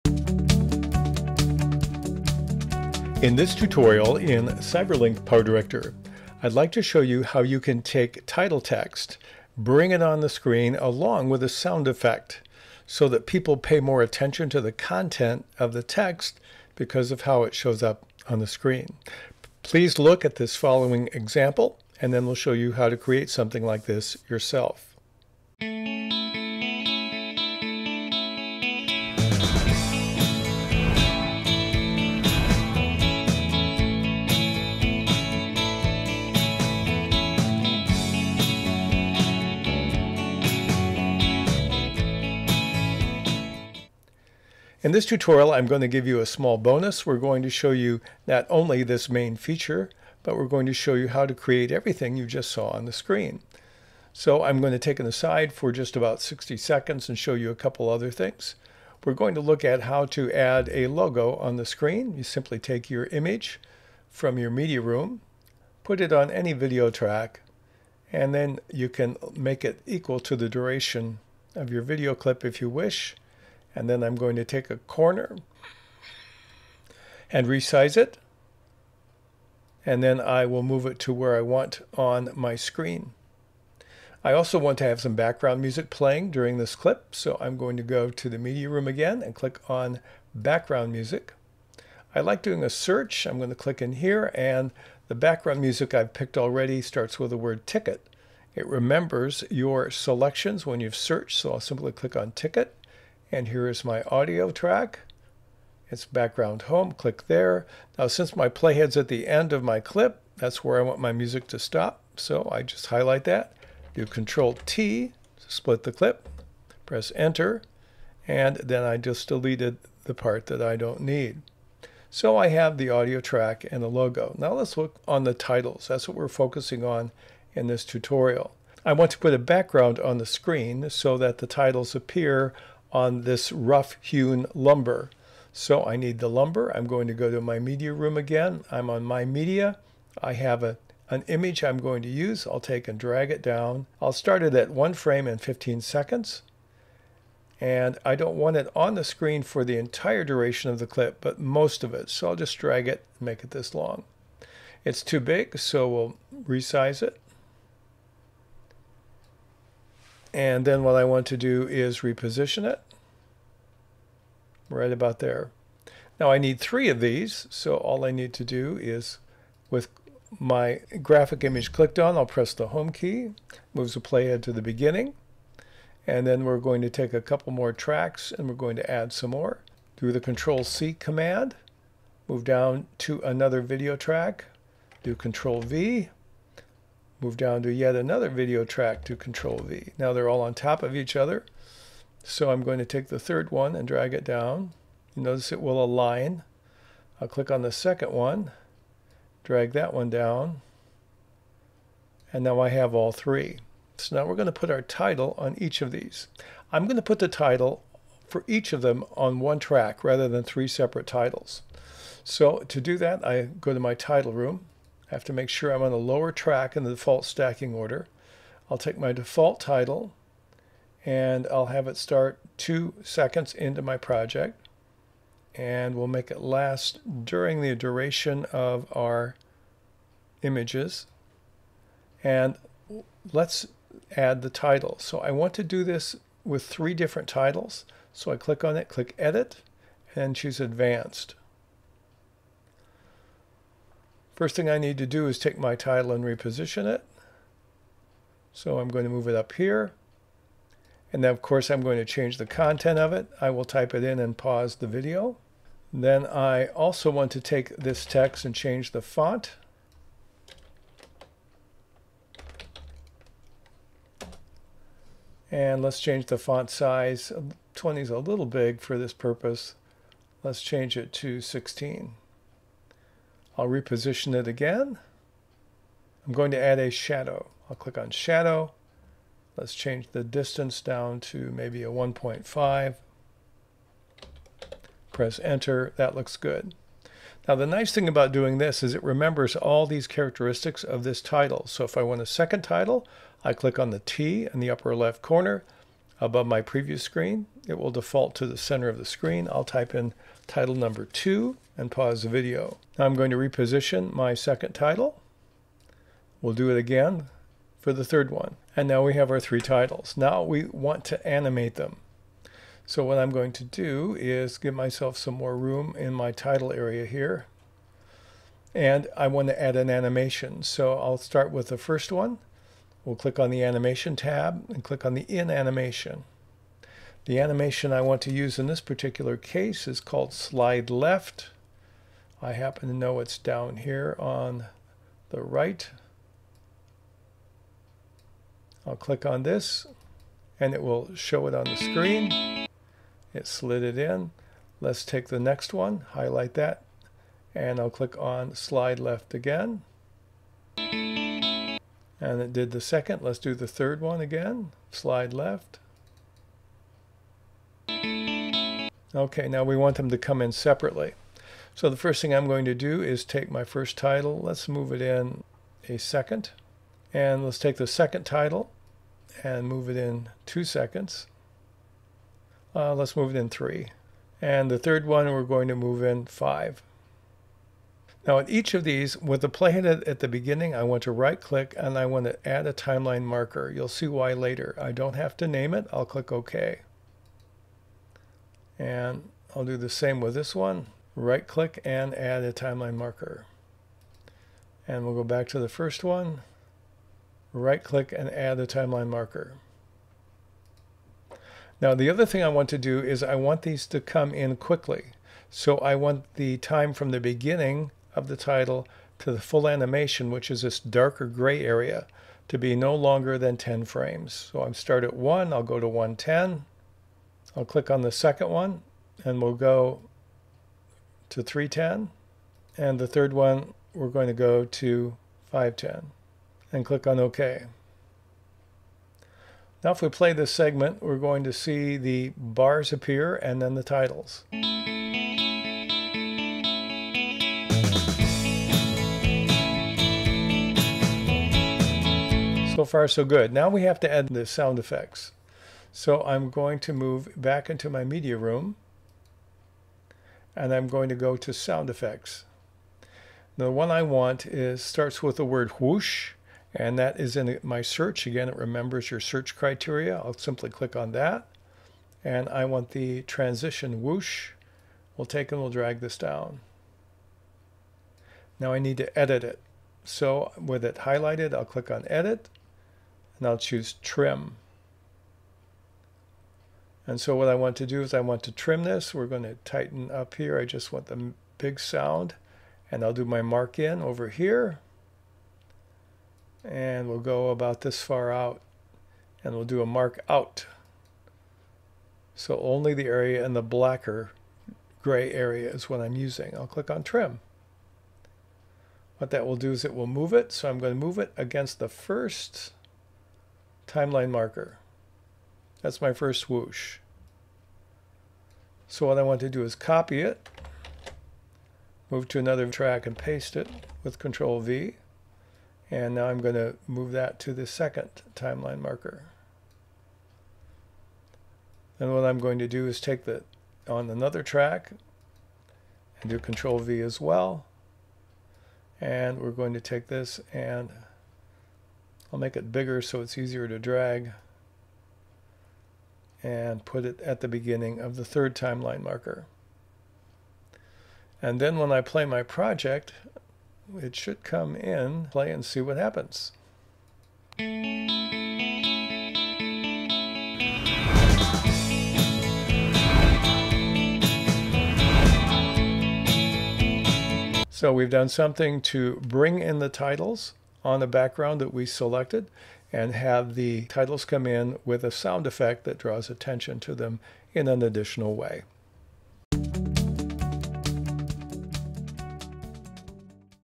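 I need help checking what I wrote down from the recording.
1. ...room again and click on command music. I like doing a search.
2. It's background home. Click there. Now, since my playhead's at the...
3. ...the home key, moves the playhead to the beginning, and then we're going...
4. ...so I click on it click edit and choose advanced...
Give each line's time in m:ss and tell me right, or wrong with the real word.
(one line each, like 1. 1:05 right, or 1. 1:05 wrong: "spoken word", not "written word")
1. 1:28 wrong: "background", not "command"
2. 1:45 right
3. 2:52 right
4. 3:58 right.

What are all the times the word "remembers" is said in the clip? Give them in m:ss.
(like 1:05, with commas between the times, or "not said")
1:38, 4:49, 7:38.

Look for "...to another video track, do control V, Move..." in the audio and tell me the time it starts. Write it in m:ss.
3:02.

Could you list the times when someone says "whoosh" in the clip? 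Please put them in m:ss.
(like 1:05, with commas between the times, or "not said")
7:35, 7:44.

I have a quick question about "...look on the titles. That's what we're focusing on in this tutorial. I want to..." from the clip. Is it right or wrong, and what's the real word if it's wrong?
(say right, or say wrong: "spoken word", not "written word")
right.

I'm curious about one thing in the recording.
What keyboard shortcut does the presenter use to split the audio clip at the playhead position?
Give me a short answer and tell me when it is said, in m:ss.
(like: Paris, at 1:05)
Control T, at 1:54.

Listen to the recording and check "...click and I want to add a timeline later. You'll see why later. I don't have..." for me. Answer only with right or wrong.
wrong.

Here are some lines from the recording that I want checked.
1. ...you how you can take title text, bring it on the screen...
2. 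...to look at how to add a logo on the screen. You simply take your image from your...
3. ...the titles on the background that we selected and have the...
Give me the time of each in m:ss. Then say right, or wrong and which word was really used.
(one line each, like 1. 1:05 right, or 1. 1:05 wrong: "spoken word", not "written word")
1. 0:07 right
2. 0:59 right
3. 9:19 right.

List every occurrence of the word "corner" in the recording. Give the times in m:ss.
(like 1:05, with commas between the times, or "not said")
1:14, 4:55.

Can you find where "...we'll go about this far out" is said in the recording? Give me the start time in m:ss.
8:07.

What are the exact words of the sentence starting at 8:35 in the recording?
And now I'm going to move that to the second timeline marker.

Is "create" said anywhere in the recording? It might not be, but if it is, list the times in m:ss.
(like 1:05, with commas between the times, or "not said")
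0:22, 0:51.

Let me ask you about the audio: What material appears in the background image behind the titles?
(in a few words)
rough hewn lumber.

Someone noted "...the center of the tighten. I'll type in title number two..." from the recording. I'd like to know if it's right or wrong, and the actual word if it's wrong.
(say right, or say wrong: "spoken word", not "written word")
wrong: "screen", not "tighten".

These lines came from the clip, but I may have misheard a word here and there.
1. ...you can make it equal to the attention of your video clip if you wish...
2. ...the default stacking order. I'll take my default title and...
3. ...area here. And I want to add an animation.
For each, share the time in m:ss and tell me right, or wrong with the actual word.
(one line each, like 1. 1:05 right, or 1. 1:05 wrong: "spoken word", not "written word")
1. 1:08 wrong: "duration", not "attention"
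2. 3:36 right
3. 5:16 right.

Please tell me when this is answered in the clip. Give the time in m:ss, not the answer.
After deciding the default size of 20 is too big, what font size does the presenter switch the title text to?
4:31.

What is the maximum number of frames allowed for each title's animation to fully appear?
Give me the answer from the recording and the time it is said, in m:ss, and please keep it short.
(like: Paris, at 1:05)
10, at 6:53.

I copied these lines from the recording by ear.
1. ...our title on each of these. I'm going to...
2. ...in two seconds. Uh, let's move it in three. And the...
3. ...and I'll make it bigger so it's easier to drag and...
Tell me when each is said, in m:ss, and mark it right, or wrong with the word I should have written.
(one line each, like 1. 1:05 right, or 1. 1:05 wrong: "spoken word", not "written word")
1. 3:24 right
2. 6:09 right
3. 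8:50 right.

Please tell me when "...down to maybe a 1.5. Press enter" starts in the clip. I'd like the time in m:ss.
4:40.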